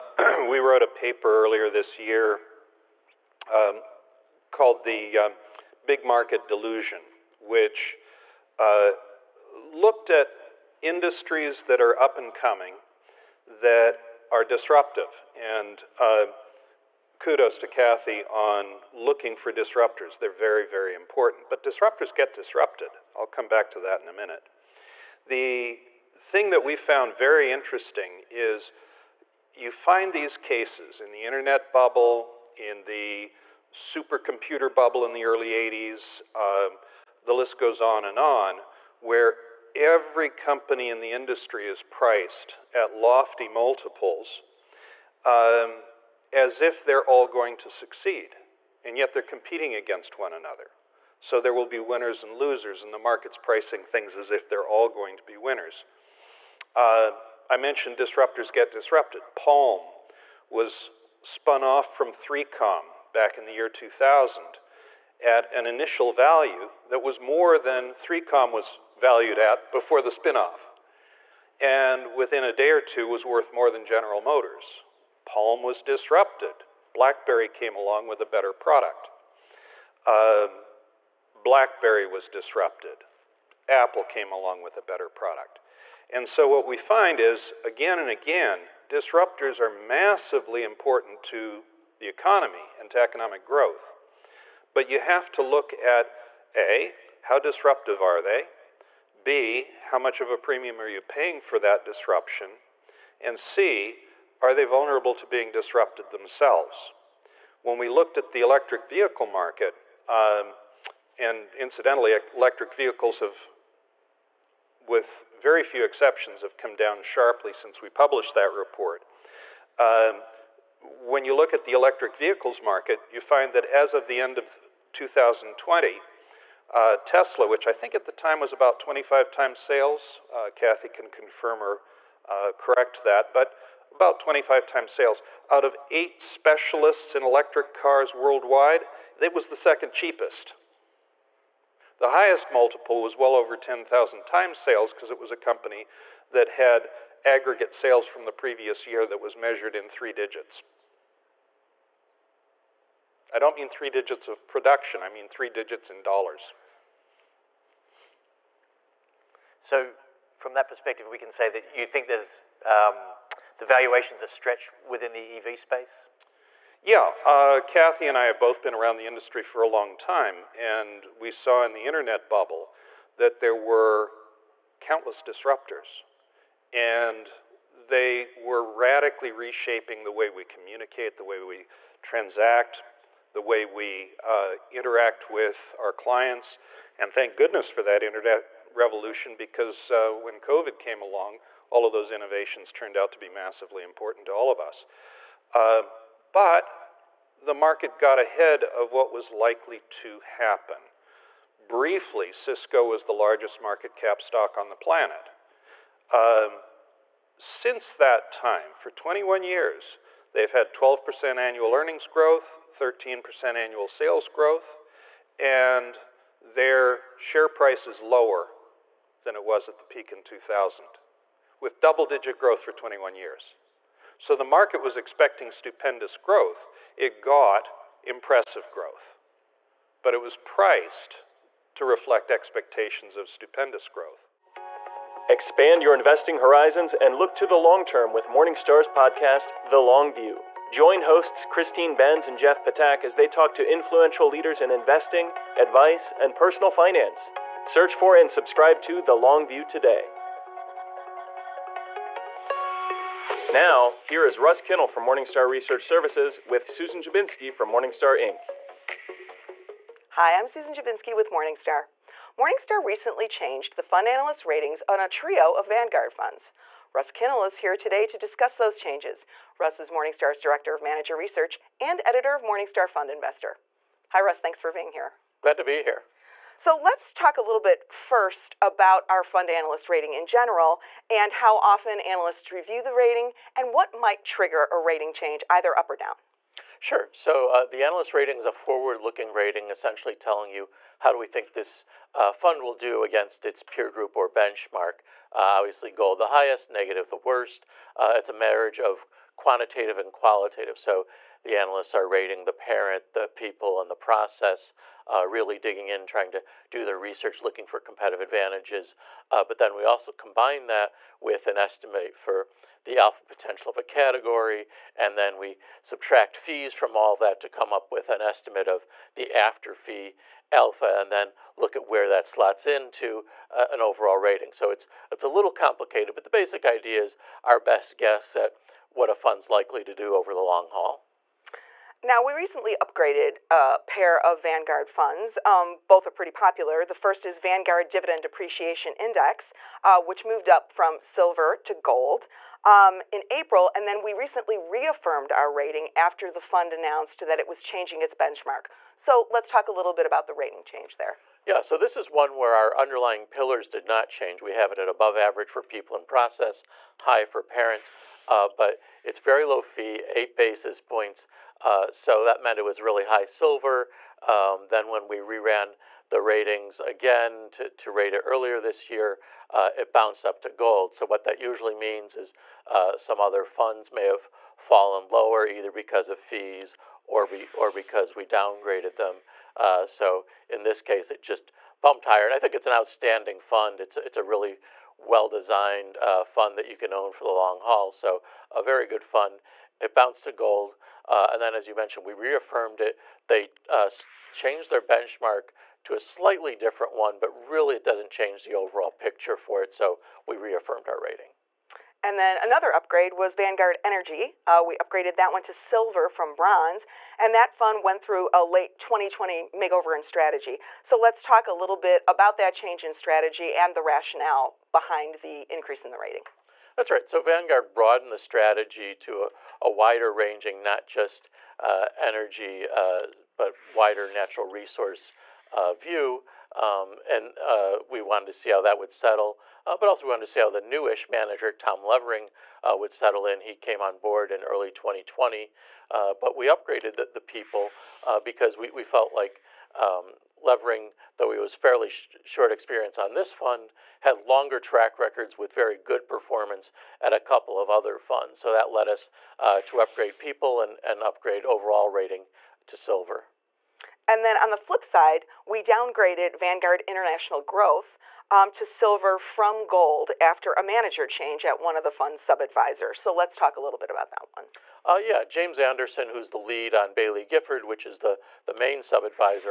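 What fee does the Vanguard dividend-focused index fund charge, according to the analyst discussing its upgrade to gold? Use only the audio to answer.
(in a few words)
8 basis points.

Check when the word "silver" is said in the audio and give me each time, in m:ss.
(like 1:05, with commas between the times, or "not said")
5:41, 6:03, 6:45, 7:32, 7:38.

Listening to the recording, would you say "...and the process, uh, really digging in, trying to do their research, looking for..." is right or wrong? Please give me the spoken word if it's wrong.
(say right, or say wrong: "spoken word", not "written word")
right.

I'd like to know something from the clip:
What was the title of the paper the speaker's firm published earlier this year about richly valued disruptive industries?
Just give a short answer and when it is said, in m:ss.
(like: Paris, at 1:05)
Big Market Delusion, at 0:05.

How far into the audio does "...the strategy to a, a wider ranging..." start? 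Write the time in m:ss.
6:58.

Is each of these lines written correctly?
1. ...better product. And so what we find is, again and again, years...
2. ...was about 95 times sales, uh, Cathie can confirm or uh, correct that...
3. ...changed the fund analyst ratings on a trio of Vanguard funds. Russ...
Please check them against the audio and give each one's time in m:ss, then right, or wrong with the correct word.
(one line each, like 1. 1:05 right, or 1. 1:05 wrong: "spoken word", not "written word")
1. 1:24 wrong: "disruptors", not "years"
2. 2:08 wrong: "25", not "95"
3. 4:23 right.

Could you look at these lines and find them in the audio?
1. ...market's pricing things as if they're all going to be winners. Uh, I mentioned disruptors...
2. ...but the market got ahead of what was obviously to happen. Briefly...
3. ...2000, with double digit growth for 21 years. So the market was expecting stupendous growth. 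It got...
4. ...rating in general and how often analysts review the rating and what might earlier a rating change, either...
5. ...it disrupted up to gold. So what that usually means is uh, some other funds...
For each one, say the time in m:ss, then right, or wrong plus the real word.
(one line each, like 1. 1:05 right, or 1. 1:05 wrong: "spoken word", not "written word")
1. 0:52 right
2. 3:16 wrong: "likely", not "obviously"
3. 3:40 right
4. 4:39 wrong: "trigger", not "earlier"
5. 6:09 wrong: "bounced", not "disrupted".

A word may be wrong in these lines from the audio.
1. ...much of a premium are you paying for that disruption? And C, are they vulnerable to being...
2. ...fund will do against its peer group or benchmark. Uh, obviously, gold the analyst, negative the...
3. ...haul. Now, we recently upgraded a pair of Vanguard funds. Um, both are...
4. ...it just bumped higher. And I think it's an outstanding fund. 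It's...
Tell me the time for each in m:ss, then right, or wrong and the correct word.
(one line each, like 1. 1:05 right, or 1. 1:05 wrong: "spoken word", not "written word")
1. 1:39 right
2. 4:52 wrong: "highest", not "analyst"
3. 5:30 right
4. 6:21 right.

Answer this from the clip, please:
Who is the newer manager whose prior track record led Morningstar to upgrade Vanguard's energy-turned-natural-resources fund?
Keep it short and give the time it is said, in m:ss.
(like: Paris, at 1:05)
Tom Levering, at 7:11.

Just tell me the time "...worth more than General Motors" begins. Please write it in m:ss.
1:13.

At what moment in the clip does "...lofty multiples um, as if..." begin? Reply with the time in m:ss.
0:42.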